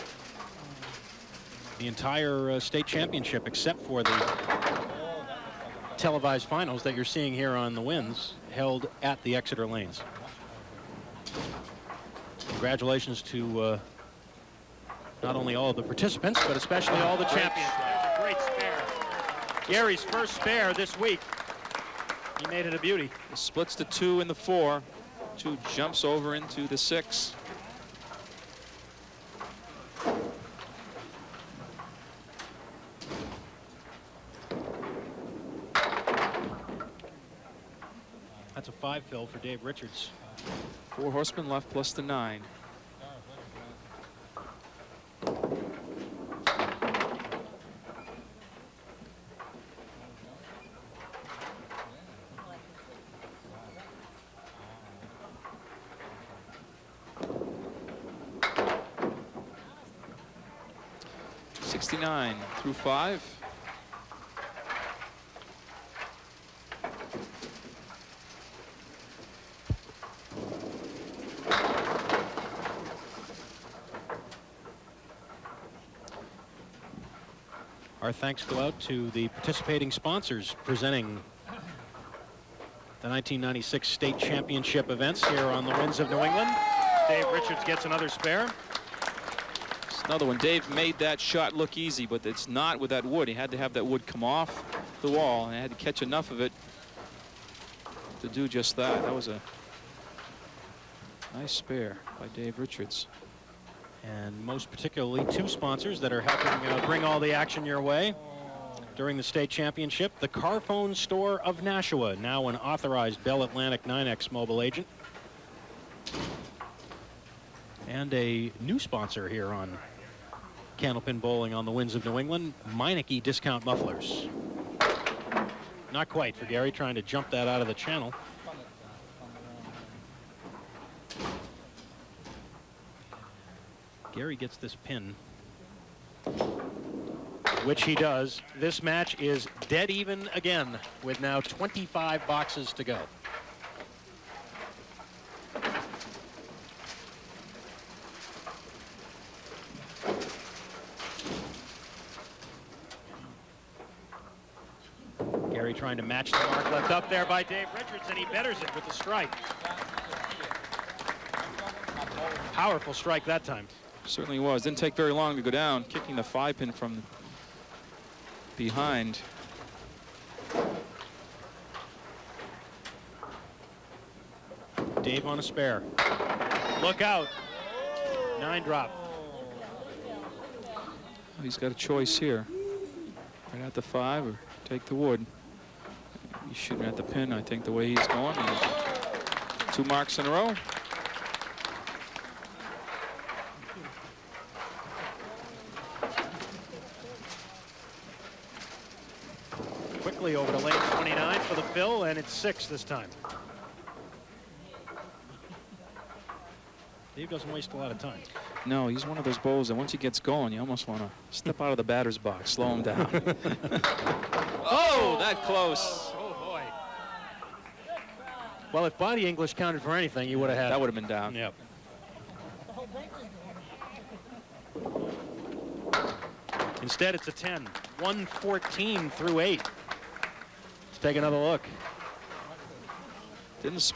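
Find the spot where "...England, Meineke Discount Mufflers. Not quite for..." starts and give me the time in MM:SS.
02:02.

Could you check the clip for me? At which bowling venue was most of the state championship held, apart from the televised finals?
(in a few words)
Exeter lanes.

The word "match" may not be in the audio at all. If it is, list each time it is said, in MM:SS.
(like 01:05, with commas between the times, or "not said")
02:18, 02:36.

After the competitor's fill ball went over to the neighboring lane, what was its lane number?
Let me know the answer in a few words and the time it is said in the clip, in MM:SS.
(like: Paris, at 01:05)
29, at 03:20.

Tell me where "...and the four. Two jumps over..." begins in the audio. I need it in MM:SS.
00:24.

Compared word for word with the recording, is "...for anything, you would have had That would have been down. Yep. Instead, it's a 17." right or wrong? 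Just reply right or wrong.
wrong.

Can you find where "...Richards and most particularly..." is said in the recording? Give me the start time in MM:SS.
01:42.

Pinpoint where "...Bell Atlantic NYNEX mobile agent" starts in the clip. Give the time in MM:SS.
01:53.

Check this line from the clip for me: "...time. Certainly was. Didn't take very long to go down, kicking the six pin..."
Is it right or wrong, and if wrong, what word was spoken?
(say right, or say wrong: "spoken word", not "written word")
wrong: "five", not "six".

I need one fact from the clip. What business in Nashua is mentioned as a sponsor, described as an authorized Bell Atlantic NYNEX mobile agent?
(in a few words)
The Carphone Store.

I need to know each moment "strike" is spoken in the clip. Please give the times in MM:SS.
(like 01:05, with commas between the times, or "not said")
02:38, 02:42.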